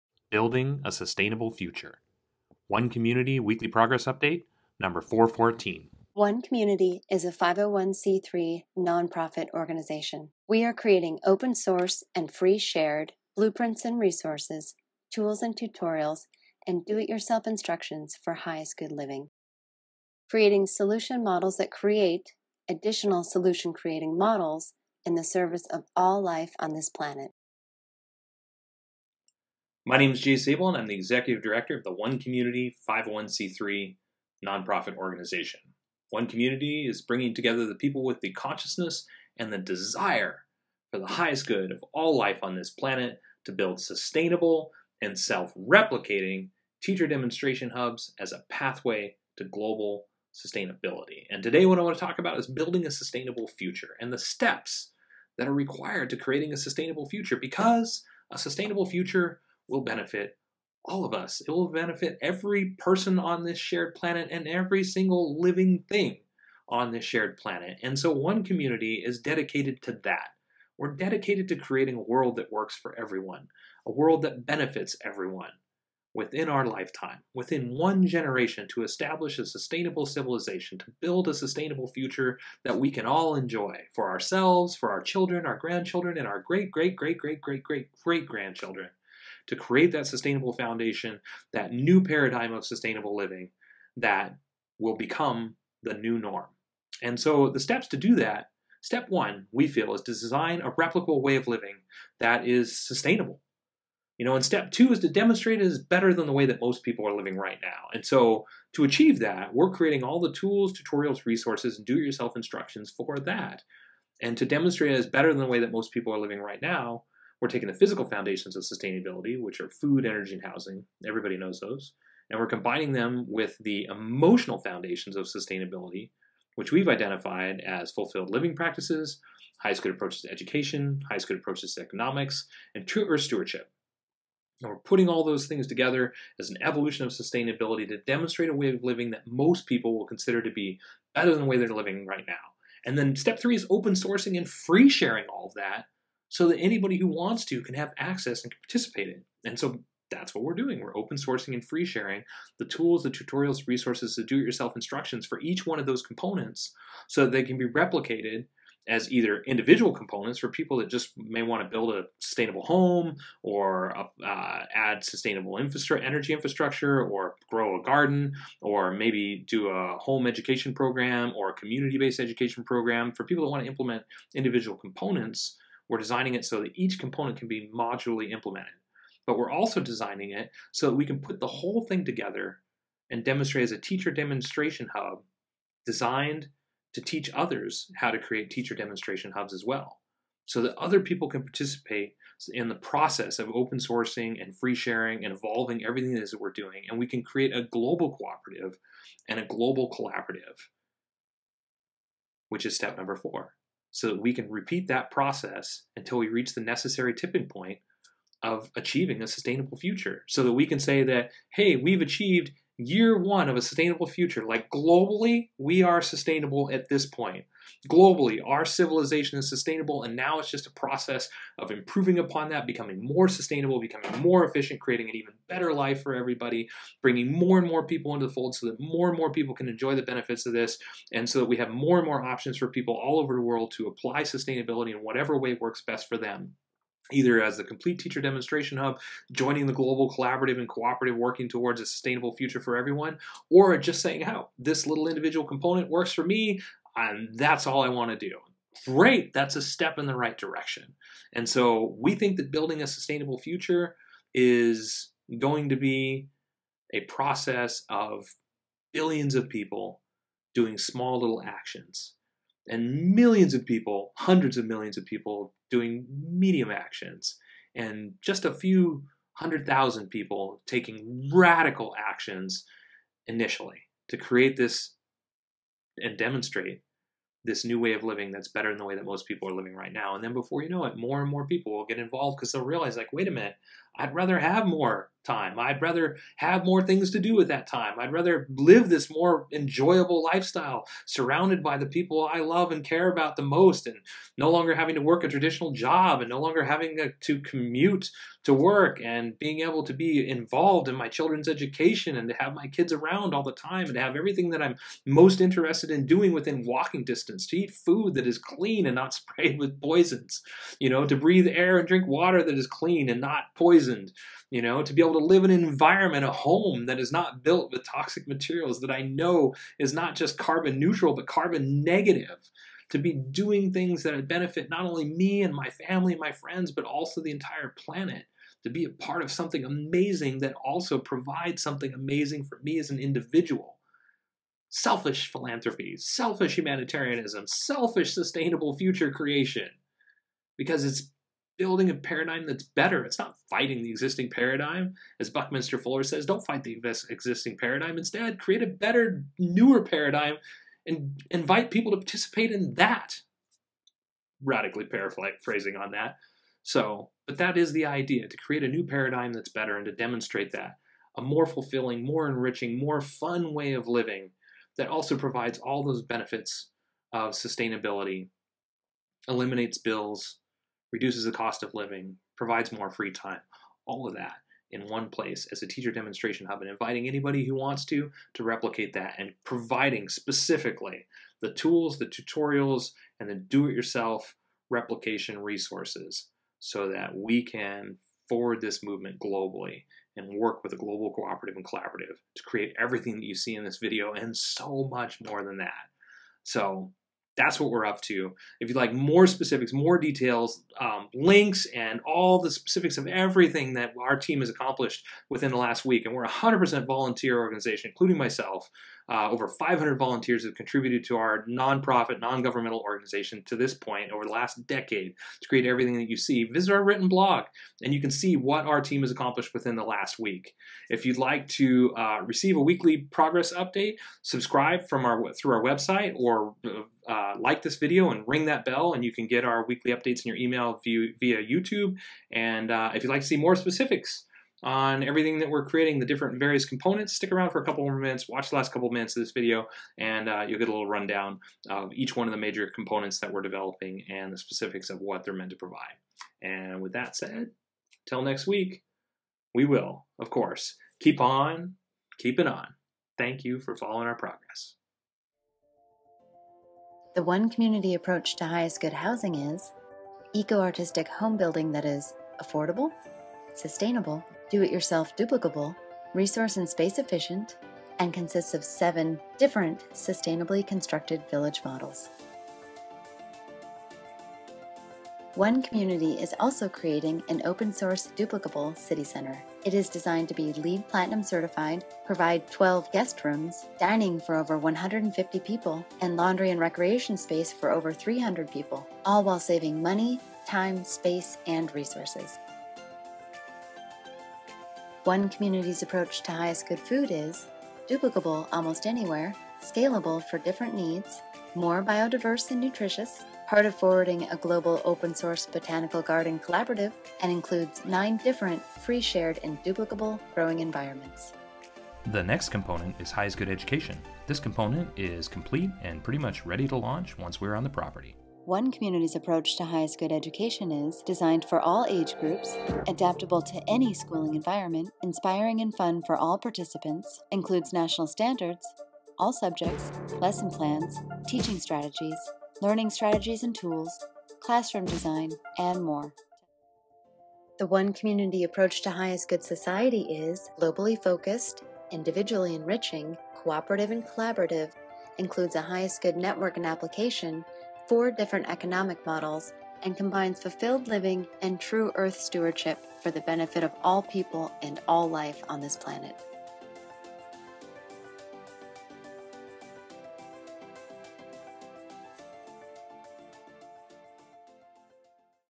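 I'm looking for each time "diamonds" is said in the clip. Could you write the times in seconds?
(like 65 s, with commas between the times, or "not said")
not said.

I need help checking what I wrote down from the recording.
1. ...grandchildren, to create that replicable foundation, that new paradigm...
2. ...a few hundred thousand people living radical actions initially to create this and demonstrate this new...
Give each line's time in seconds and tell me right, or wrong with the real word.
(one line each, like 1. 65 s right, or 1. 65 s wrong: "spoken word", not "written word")
1. 88 s wrong: "sustainable", not "replicable"
2. 268 s wrong: "taking", not "living".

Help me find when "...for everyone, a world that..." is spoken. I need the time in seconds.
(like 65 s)
72 s.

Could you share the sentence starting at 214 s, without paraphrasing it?
Like globally, we are sustainable at this point.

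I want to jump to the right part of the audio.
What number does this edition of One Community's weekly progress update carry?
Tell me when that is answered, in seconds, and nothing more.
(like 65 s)
5 s.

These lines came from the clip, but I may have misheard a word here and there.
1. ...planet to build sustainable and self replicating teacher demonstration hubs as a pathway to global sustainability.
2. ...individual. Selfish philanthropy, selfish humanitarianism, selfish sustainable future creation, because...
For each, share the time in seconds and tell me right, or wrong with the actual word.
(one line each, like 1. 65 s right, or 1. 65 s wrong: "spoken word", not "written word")
1. 42 s right
2. 332 s right.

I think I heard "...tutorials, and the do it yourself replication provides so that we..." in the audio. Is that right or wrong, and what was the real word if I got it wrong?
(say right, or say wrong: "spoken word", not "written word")
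wrong: "resources", not "provides".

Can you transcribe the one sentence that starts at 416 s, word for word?
Visit our written blog and you can see what our team has accomplished within the last week.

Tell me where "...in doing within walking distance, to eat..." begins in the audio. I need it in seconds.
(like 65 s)
305 s.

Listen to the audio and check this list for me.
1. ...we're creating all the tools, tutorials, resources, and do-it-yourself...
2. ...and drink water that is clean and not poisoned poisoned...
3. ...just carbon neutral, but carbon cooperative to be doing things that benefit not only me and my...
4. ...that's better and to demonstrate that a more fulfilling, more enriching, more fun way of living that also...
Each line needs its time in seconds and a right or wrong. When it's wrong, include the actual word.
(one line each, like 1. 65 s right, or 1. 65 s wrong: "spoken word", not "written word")
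1. 109 s right
2. 311 s right
3. 320 s wrong: "negative", not "cooperative"
4. 359 s right.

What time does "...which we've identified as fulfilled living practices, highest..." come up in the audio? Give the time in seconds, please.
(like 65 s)
126 s.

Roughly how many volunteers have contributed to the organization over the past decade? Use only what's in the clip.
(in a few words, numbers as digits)
Over 500.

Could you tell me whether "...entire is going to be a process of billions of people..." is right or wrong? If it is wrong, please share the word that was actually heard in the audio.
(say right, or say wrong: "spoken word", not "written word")
wrong: "future", not "entire".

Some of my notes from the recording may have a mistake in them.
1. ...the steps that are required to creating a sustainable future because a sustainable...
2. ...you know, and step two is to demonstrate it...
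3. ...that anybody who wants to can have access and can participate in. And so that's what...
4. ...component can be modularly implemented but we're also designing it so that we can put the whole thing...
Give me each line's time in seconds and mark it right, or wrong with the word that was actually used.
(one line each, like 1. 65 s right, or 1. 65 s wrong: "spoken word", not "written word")
1. 54 s right
2. 104 s right
3. 146 s right
4. 176 s right.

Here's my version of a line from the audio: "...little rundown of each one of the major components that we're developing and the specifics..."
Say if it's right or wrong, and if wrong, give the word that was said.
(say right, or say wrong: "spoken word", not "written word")
right.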